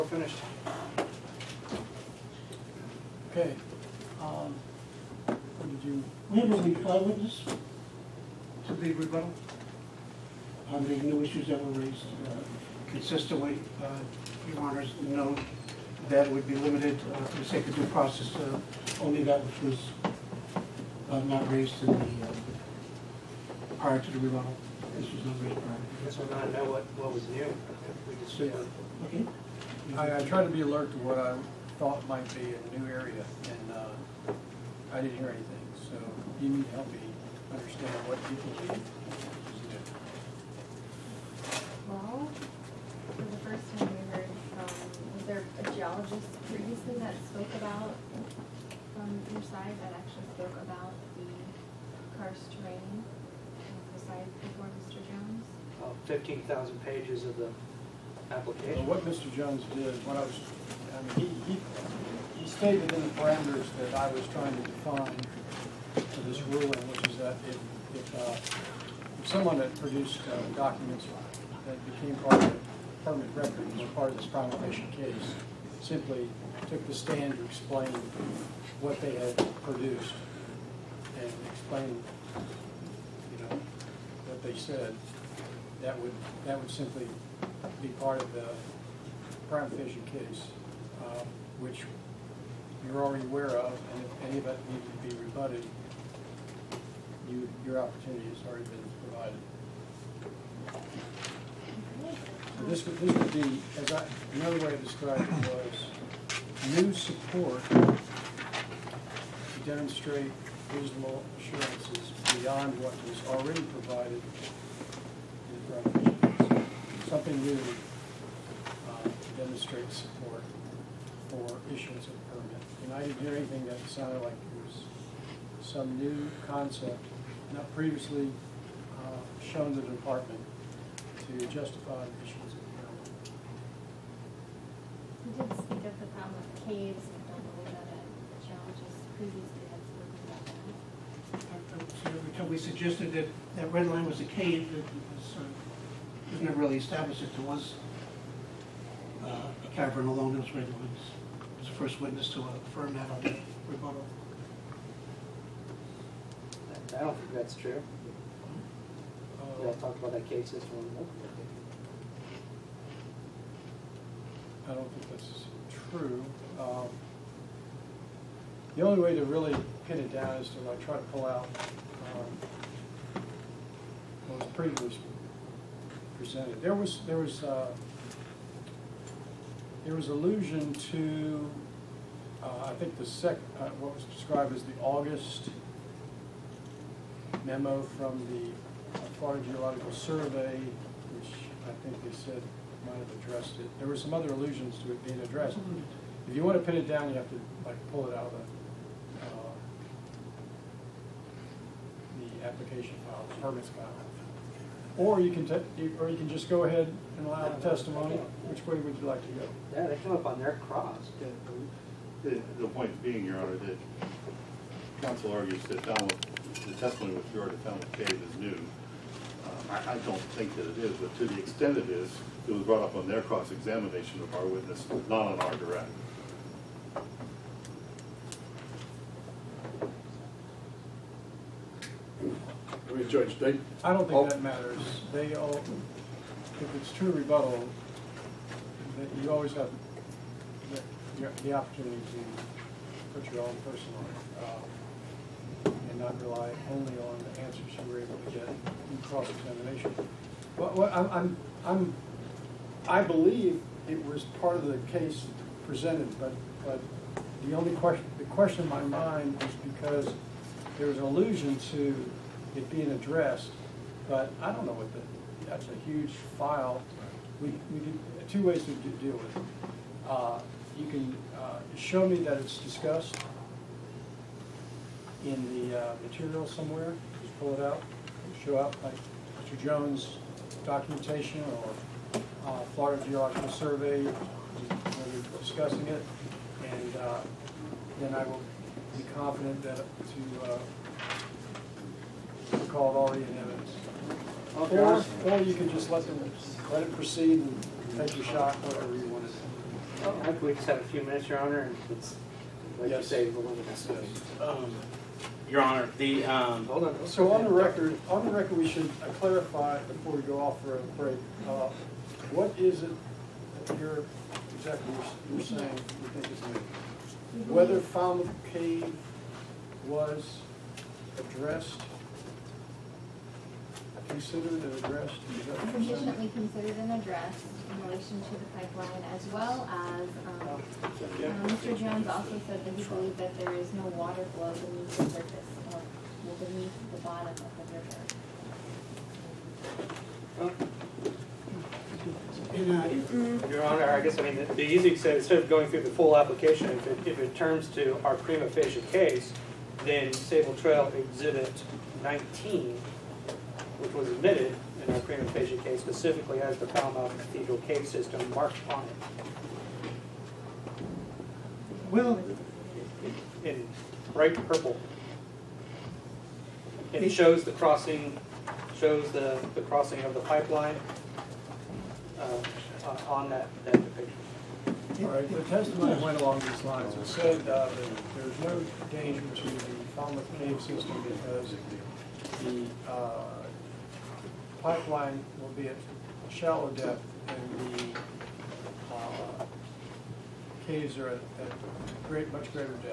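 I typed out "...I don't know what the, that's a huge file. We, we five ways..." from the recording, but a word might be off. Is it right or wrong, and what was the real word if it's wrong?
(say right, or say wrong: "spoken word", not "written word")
wrong: "two", not "five".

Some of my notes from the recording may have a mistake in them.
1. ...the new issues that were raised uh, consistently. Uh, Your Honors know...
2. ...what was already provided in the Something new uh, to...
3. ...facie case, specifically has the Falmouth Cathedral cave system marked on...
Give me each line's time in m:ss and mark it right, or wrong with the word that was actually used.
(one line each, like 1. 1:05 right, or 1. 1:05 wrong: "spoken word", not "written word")
1. 0:10 right
2. 1:52 right
3. 5:55 right.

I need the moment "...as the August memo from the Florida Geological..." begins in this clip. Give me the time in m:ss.
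3:04.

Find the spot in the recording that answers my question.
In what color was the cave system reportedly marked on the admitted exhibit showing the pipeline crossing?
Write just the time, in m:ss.
6:04.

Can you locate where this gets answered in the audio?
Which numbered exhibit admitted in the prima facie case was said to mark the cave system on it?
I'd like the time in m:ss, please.
5:50.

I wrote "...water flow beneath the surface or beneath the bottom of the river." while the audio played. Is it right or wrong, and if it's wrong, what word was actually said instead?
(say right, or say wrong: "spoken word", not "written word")
right.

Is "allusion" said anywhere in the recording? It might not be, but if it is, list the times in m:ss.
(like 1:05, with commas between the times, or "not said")
3:00, 3:14, 4:20.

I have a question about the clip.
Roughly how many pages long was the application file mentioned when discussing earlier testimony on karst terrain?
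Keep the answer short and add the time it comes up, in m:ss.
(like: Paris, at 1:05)
15,000, at 0:56.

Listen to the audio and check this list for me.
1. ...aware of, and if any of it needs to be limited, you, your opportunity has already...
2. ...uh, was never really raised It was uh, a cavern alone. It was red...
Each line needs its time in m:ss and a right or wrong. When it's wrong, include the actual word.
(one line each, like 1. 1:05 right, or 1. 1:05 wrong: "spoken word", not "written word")
1. 1:33 wrong: "rebutted", not "limited"
2. 2:25 wrong: "established", not "raised".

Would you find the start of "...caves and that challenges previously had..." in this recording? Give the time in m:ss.
2:16.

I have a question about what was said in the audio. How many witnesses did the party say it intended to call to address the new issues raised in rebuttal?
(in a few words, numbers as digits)
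5.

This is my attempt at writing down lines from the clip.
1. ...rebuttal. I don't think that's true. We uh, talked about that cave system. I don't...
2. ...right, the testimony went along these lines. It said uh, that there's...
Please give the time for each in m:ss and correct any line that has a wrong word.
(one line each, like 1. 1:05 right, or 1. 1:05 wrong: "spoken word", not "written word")
1. 2:33 right
2. 6:15 right.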